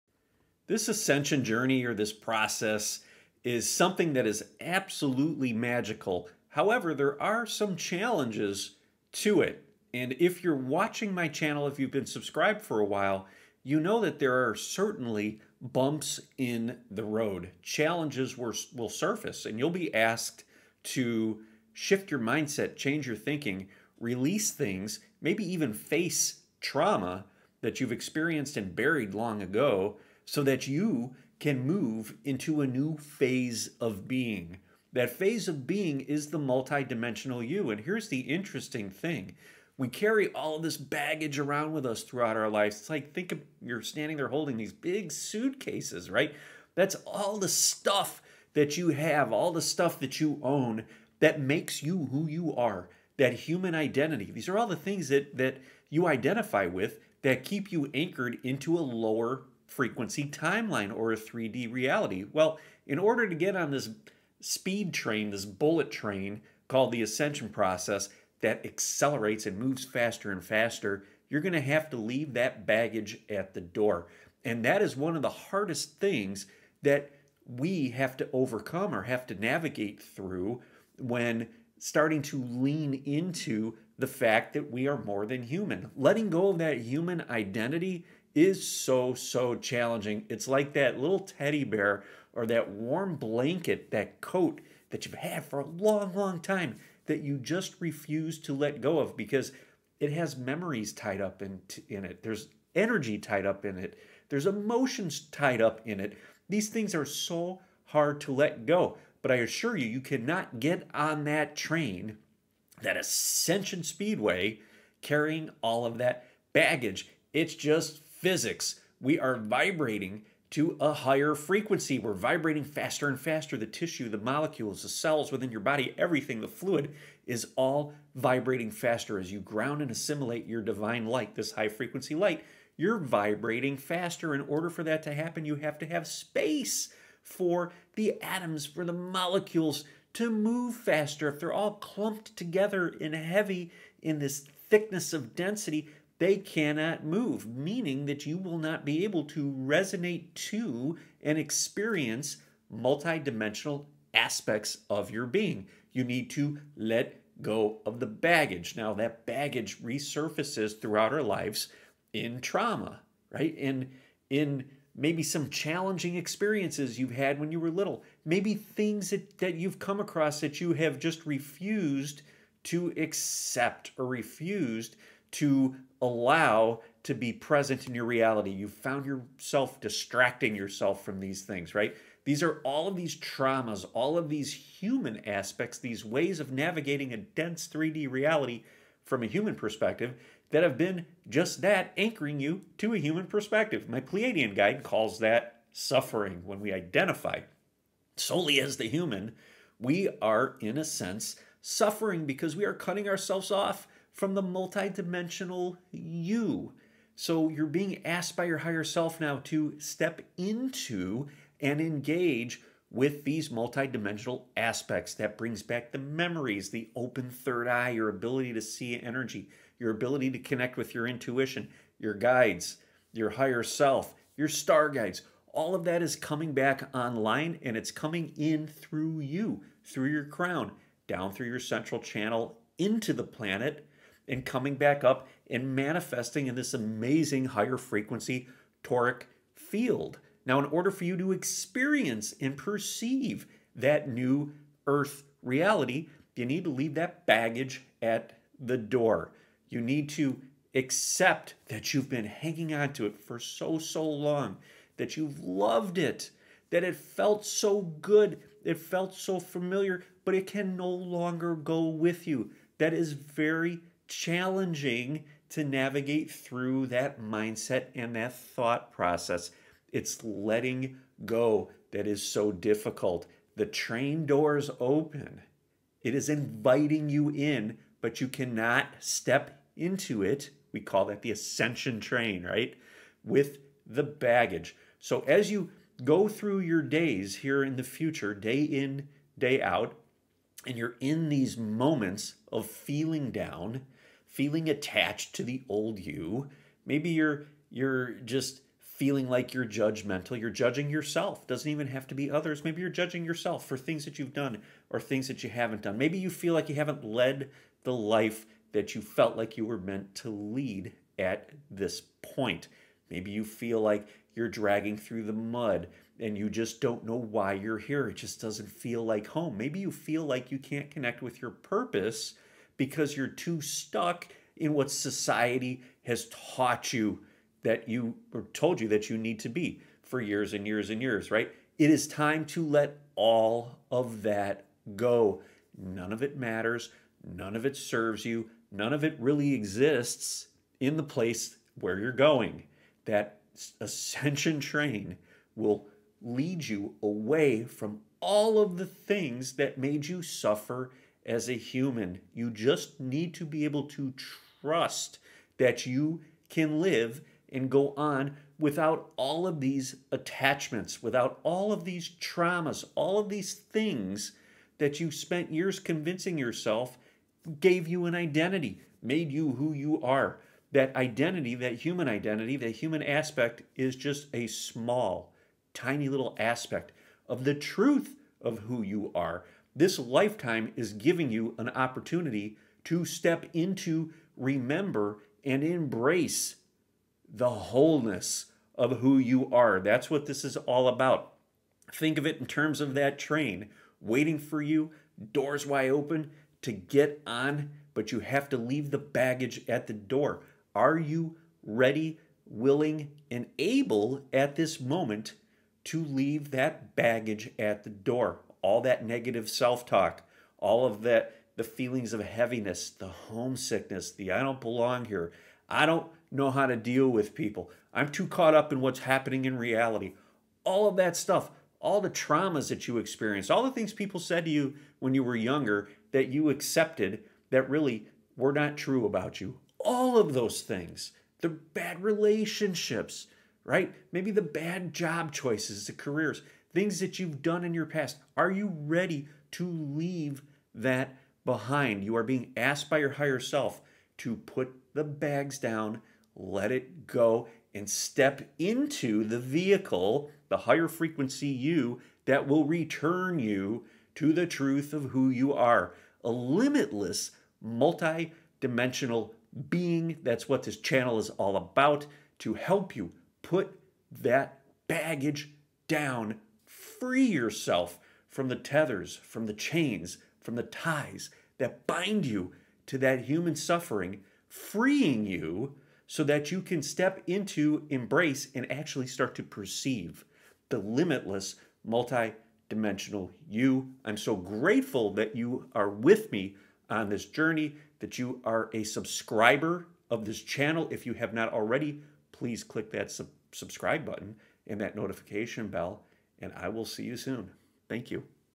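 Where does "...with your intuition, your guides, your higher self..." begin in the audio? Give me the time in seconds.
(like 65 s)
220 s.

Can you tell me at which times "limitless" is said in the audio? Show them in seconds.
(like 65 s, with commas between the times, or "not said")
456 s, 480 s.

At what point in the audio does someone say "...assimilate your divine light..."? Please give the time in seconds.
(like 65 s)
129 s.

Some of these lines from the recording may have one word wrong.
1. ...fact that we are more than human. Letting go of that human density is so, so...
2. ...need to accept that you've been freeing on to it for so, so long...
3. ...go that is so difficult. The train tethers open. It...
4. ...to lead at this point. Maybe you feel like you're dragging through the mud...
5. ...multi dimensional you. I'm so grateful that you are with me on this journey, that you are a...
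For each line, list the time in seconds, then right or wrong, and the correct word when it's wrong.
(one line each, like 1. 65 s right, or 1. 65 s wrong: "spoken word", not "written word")
1. 84 s wrong: "identity", not "density"
2. 249 s wrong: "hanging", not "freeing"
3. 271 s wrong: "doors", not "tethers"
4. 310 s right
5. 481 s right.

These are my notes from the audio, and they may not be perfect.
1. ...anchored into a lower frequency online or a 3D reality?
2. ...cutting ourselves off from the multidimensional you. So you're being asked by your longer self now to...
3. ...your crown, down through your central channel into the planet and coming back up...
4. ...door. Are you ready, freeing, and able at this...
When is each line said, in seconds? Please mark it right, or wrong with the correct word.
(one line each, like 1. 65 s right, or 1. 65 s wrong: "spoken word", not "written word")
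1. 57 s wrong: "timeline", not "online"
2. 202 s wrong: "higher", not "longer"
3. 230 s right
4. 399 s wrong: "willing", not "freeing".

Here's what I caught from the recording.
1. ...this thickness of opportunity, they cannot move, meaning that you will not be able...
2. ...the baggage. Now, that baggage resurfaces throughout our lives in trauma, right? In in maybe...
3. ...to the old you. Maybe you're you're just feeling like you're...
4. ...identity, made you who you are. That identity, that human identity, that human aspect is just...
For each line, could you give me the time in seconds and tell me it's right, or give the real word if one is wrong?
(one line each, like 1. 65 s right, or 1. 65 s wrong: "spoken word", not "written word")
1. 144 s wrong: "density", not "opportunity"
2. 157 s right
3. 295 s right
4. 368 s right.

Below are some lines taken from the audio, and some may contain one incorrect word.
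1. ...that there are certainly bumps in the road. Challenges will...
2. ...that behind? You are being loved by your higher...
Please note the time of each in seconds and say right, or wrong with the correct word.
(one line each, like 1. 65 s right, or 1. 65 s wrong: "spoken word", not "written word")
1. 13 s right
2. 440 s wrong: "asked", not "loved".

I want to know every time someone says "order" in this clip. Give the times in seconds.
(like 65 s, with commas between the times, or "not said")
62 s, 134 s, 240 s.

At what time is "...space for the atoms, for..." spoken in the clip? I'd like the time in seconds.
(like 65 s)
136 s.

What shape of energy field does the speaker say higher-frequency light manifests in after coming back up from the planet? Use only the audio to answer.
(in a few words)
toric field.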